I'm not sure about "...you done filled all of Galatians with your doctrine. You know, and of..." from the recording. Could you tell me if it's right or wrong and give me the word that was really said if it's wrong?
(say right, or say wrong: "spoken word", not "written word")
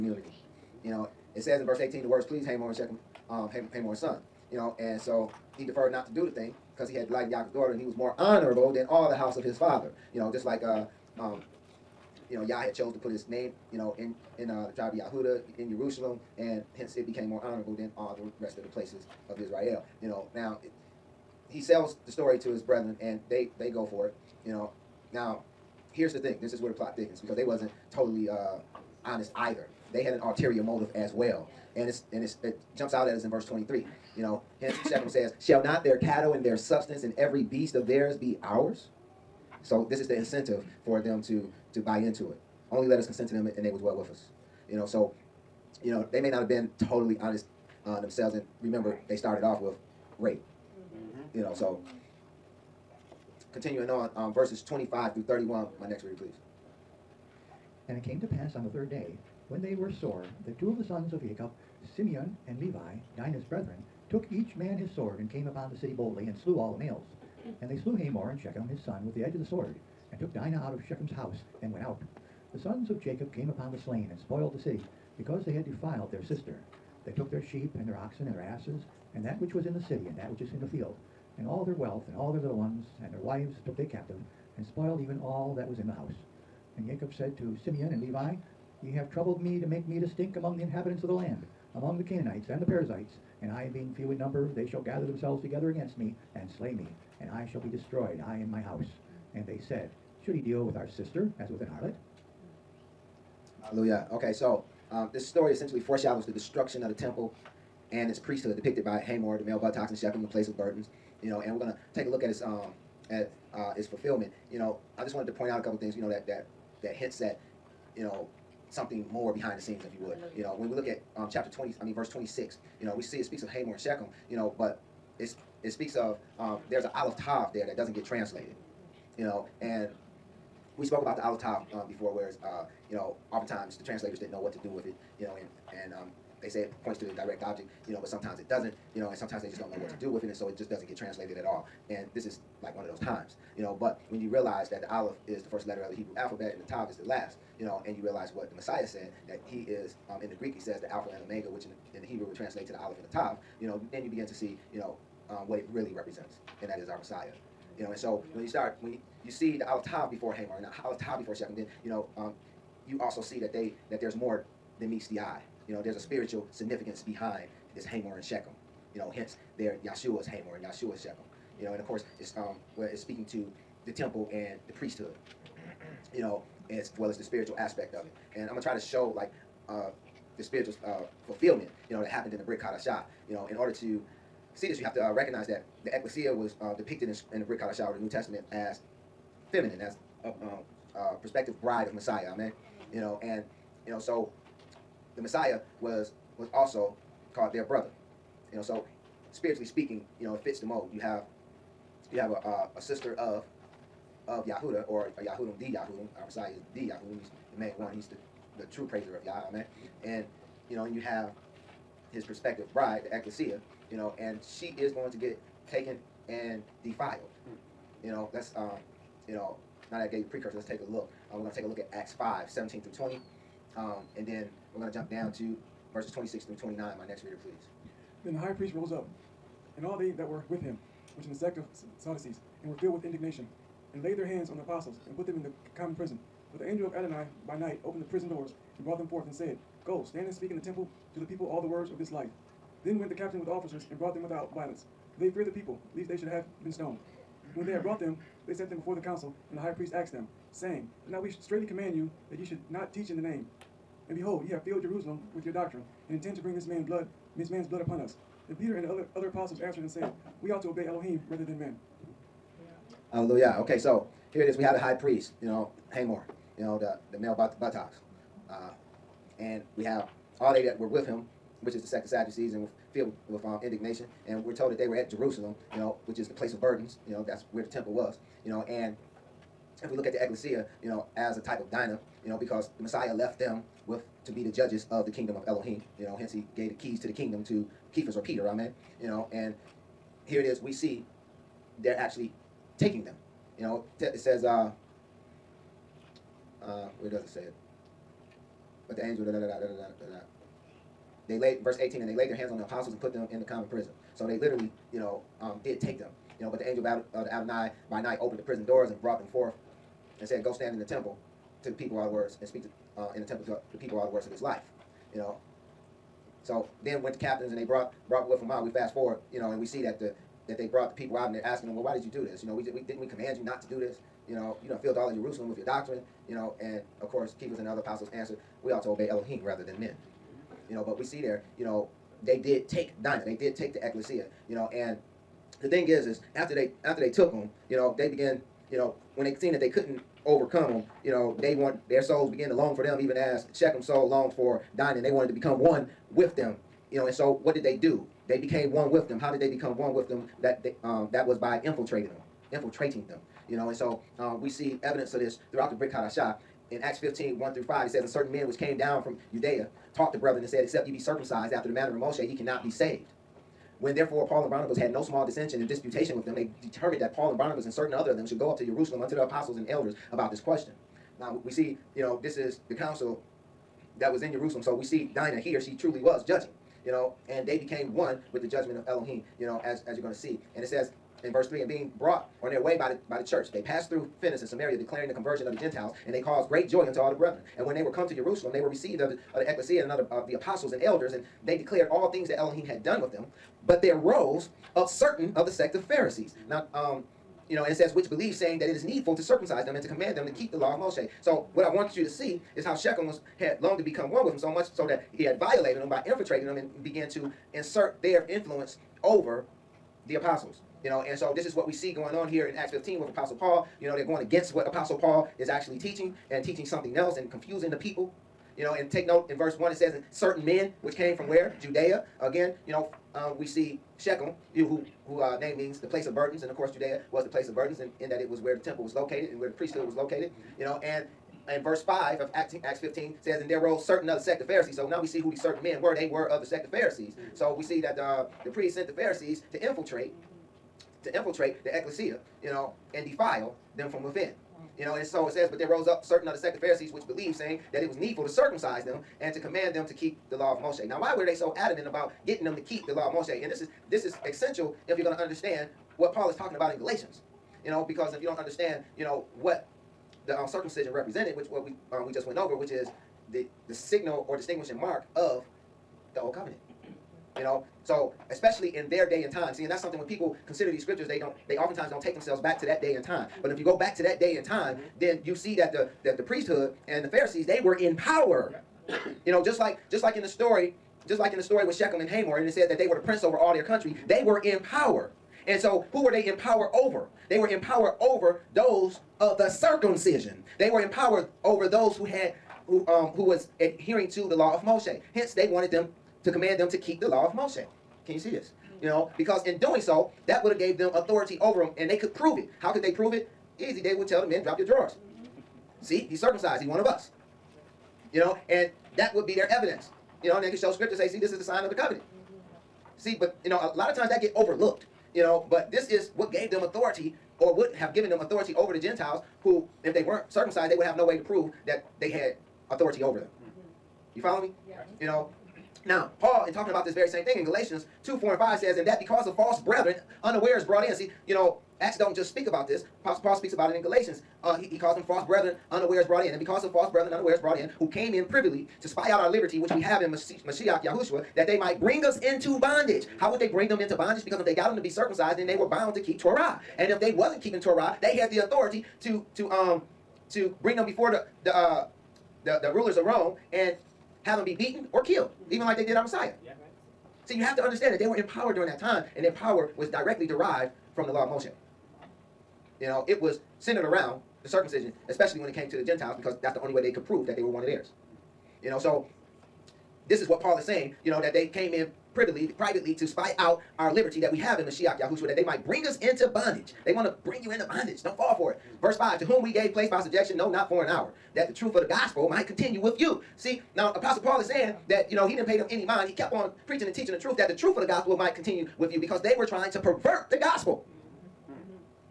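wrong: "Jerusalem", not "Galatians".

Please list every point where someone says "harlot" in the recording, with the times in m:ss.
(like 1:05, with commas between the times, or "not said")
1:41.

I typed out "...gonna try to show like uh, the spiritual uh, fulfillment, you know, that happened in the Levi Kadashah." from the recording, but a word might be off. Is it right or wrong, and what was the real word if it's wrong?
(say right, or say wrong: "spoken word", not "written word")
wrong: "Brit", not "Levi".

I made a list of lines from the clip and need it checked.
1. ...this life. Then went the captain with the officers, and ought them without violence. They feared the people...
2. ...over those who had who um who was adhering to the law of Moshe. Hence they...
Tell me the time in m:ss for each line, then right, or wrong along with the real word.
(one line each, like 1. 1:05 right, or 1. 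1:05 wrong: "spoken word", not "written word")
1. 4:01 wrong: "brought", not "ought"
2. 8:11 right.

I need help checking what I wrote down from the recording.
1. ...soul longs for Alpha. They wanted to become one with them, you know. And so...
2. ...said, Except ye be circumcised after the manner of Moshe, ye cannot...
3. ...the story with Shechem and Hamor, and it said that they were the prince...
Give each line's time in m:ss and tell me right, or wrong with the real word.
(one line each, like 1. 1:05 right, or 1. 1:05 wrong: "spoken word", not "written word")
1. 5:43 wrong: "Dinah", not "Alpha"
2. 6:00 right
3. 8:01 right.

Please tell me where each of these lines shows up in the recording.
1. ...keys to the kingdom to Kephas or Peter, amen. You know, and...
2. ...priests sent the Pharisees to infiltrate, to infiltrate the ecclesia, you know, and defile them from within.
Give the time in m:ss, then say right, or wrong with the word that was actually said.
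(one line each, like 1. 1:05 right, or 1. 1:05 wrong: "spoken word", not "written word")
1. 4:46 right
2. 7:18 right.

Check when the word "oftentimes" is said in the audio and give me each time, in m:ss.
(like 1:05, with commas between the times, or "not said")
2:13, 7:51.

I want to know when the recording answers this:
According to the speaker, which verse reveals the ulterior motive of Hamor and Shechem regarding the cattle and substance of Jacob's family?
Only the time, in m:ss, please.
0:33.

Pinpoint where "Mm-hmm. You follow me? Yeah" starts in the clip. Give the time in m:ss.
8:43.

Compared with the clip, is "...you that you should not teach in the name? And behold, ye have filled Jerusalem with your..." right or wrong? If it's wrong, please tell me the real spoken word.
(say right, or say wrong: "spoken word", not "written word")
right.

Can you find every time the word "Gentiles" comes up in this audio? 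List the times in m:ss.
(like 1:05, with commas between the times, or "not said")
6:25, 8:38, 9:25.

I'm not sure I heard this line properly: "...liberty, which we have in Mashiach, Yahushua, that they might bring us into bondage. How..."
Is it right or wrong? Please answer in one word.
right.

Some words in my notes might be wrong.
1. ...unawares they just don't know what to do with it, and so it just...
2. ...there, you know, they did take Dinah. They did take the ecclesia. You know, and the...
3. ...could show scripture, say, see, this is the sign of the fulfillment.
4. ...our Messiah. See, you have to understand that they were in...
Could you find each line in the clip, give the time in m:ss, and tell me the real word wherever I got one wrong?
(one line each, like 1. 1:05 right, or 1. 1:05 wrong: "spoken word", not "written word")
1. 2:19 wrong: "sometimes", not "unawares"
2. 5:31 right
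3. 8:30 wrong: "covenant", not "fulfillment"
4. 9:15 right.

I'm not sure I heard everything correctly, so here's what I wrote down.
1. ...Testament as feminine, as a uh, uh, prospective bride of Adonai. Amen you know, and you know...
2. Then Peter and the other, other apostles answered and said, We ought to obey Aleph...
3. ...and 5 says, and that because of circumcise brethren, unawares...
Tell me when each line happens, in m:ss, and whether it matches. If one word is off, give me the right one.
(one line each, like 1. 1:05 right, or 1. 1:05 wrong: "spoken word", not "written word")
1. 3:08 wrong: "Messiah", not "Adonai"
2. 4:18 wrong: "Elohim", not "Aleph"
3. 8:48 wrong: "false", not "circumcise".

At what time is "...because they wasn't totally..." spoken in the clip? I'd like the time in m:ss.
0:27.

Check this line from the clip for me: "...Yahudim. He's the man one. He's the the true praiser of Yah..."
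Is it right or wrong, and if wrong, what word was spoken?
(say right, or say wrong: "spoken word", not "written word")
right.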